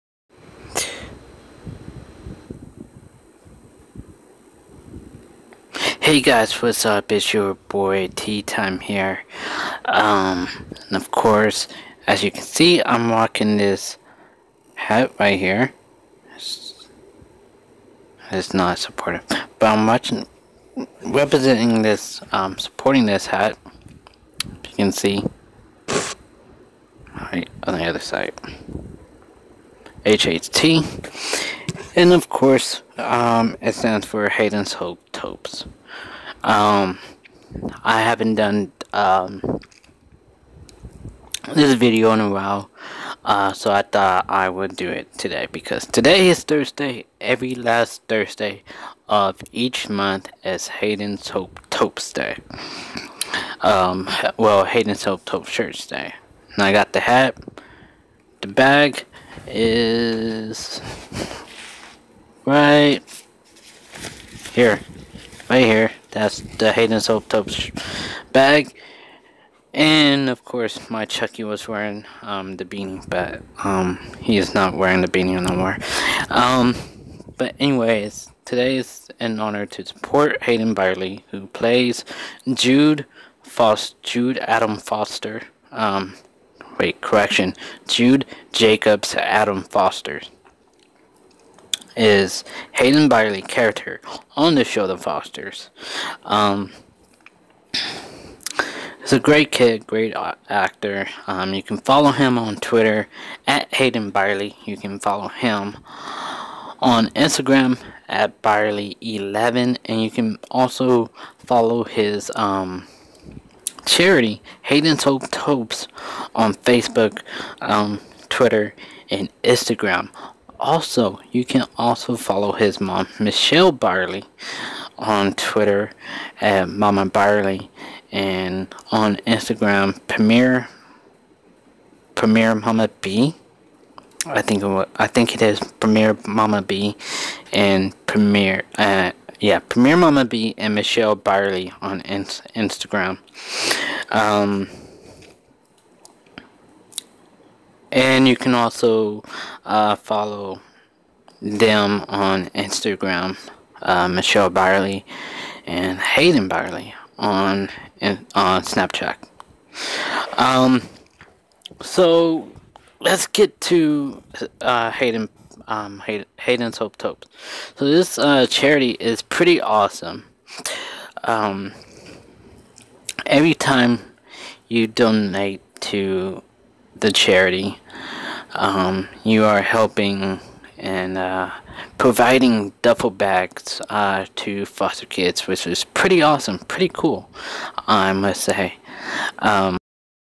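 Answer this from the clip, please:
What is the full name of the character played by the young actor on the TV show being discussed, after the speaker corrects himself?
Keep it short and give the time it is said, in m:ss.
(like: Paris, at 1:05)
Jude Jacobs Adam Foster, at 1:27.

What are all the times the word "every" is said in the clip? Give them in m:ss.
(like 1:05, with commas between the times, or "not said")
0:47, 2:53.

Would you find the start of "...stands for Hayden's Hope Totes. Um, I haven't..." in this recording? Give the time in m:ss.
0:33.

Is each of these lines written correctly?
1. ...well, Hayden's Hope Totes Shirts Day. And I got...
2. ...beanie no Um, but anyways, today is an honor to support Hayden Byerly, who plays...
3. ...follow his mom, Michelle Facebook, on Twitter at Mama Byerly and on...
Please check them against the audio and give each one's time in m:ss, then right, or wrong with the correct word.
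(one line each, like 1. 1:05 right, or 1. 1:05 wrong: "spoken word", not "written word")
1. 0:54 right
2. 1:15 right
3. 2:02 wrong: "Byerly", not "Facebook".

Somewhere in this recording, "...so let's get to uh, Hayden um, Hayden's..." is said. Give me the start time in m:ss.
2:41.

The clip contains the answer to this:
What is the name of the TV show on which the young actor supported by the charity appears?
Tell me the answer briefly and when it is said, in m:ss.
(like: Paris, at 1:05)
The Fosters, at 1:34.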